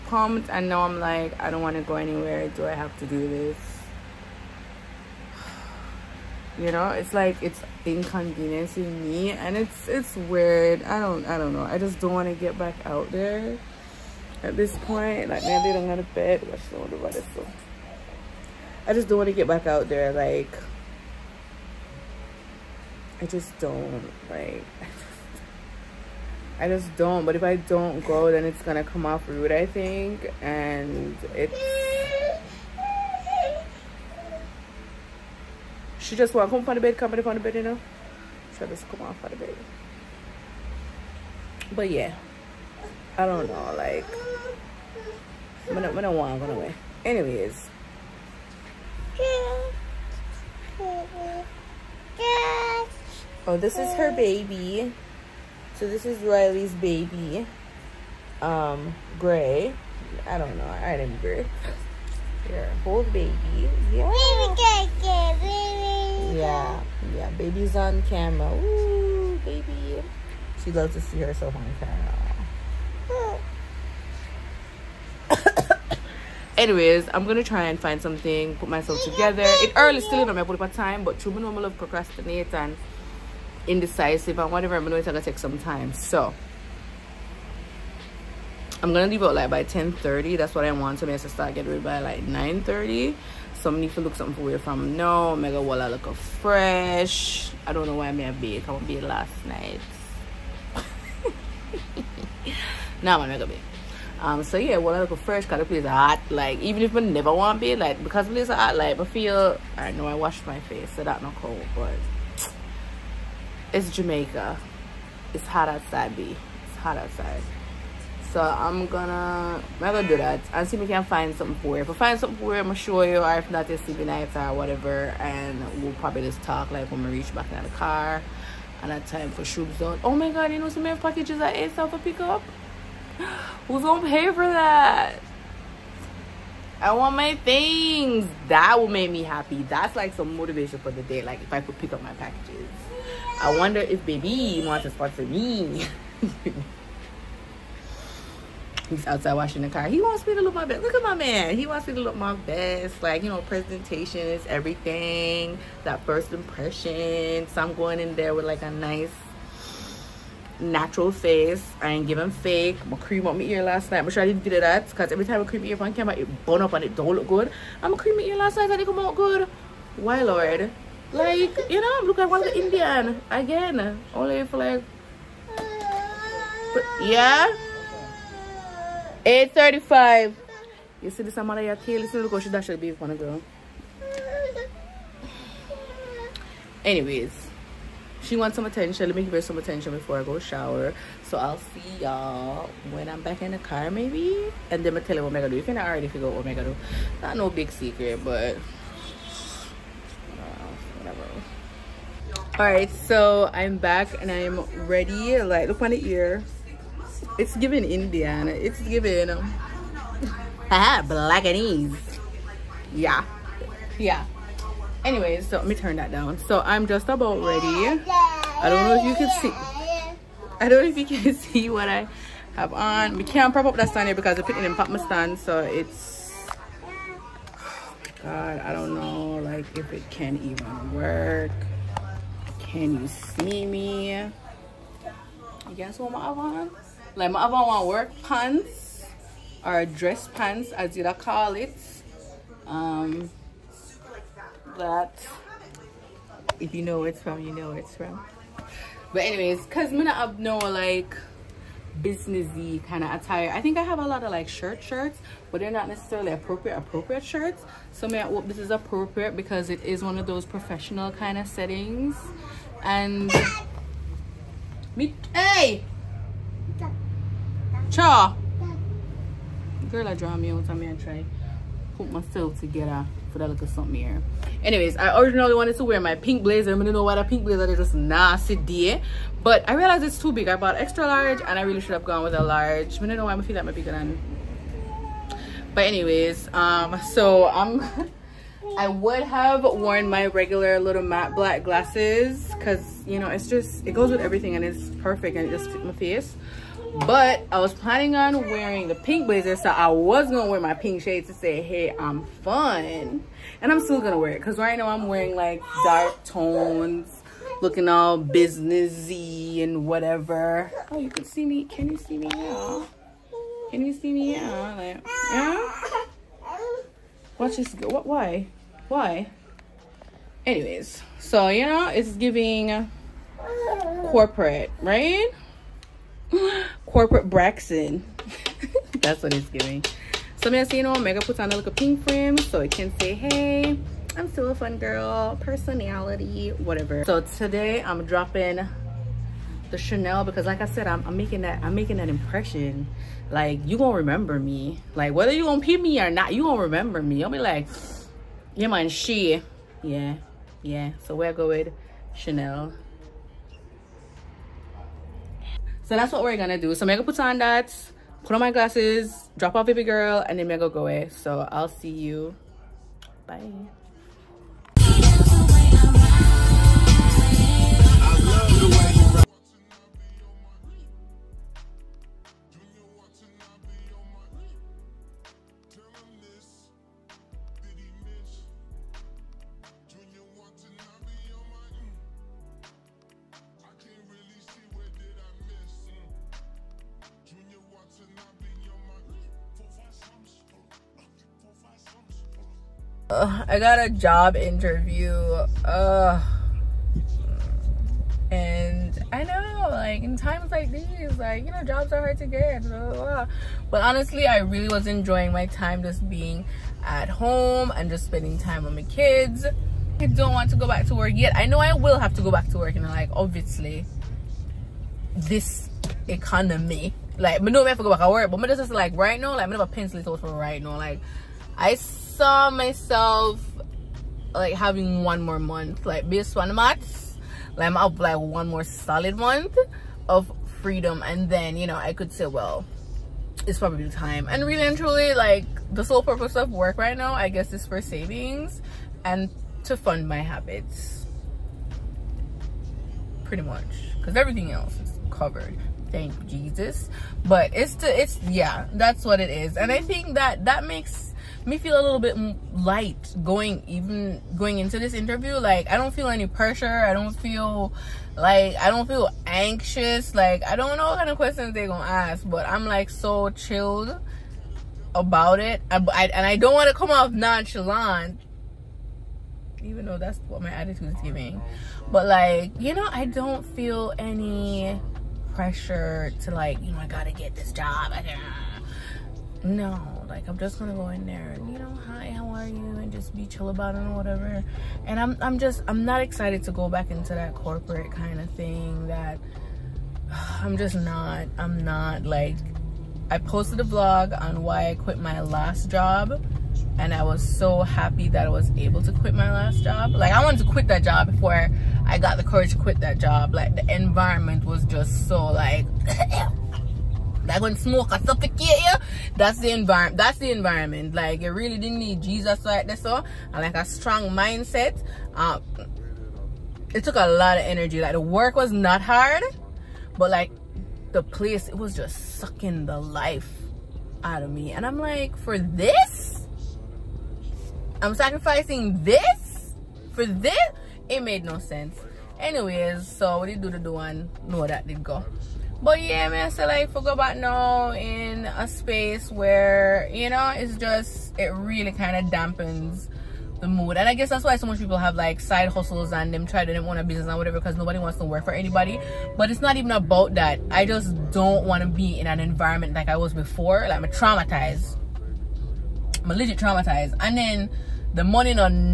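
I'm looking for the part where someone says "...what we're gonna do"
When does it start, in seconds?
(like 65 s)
356 s.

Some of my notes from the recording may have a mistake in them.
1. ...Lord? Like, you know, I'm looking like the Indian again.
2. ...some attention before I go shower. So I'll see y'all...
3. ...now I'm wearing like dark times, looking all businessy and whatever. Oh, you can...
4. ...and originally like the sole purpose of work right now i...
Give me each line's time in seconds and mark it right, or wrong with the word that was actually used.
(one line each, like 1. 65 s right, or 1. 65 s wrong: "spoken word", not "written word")
1. 170 s right
2. 189 s right
3. 304 s wrong: "tones", not "times"
4. 434 s wrong: "truly", not "originally".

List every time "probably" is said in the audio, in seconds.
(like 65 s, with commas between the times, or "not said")
125 s, 433 s.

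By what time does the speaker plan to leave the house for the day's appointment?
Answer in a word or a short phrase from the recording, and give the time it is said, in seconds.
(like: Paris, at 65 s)
10:30, at 89 s.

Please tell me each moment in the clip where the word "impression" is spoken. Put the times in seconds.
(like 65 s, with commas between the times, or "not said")
156 s, 342 s.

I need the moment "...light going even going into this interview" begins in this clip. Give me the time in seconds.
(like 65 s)
452 s.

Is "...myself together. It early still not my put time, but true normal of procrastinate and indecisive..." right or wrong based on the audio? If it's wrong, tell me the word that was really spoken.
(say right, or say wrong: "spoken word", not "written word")
right.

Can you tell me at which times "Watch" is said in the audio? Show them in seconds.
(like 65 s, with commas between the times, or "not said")
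317 s.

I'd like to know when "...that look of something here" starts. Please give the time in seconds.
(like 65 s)
273 s.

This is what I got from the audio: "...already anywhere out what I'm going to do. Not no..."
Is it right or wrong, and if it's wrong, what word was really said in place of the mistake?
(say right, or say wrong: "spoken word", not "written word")
wrong: "figure", not "anywhere".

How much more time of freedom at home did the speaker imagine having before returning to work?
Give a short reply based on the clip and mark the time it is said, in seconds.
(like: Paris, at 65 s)
One more month, at 425 s.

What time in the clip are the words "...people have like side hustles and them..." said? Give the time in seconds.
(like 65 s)
544 s.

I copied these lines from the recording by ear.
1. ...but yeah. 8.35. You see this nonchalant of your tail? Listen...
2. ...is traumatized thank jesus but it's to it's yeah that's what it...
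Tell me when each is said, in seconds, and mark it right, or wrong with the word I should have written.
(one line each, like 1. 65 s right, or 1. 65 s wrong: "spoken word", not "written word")
1. 176 s wrong: "amount", not "nonchalant"
2. 444 s wrong: "covered", not "traumatized".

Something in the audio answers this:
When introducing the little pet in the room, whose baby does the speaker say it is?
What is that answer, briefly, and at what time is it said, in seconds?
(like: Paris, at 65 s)
Riley, at 56 s.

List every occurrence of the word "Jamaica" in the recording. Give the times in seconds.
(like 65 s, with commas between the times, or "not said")
113 s.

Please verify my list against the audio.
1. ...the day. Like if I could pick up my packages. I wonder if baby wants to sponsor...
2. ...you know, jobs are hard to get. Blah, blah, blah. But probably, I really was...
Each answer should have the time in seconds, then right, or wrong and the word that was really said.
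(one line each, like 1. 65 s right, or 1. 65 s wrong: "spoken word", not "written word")
1. 140 s right
2. 401 s wrong: "honestly", not "probably".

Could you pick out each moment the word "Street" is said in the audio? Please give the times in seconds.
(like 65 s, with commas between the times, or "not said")
not said.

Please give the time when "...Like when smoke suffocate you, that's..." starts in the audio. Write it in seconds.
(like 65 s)
507 s.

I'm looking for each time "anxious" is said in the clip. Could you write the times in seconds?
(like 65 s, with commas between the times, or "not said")
459 s.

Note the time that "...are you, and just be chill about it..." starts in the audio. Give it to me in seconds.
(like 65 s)
482 s.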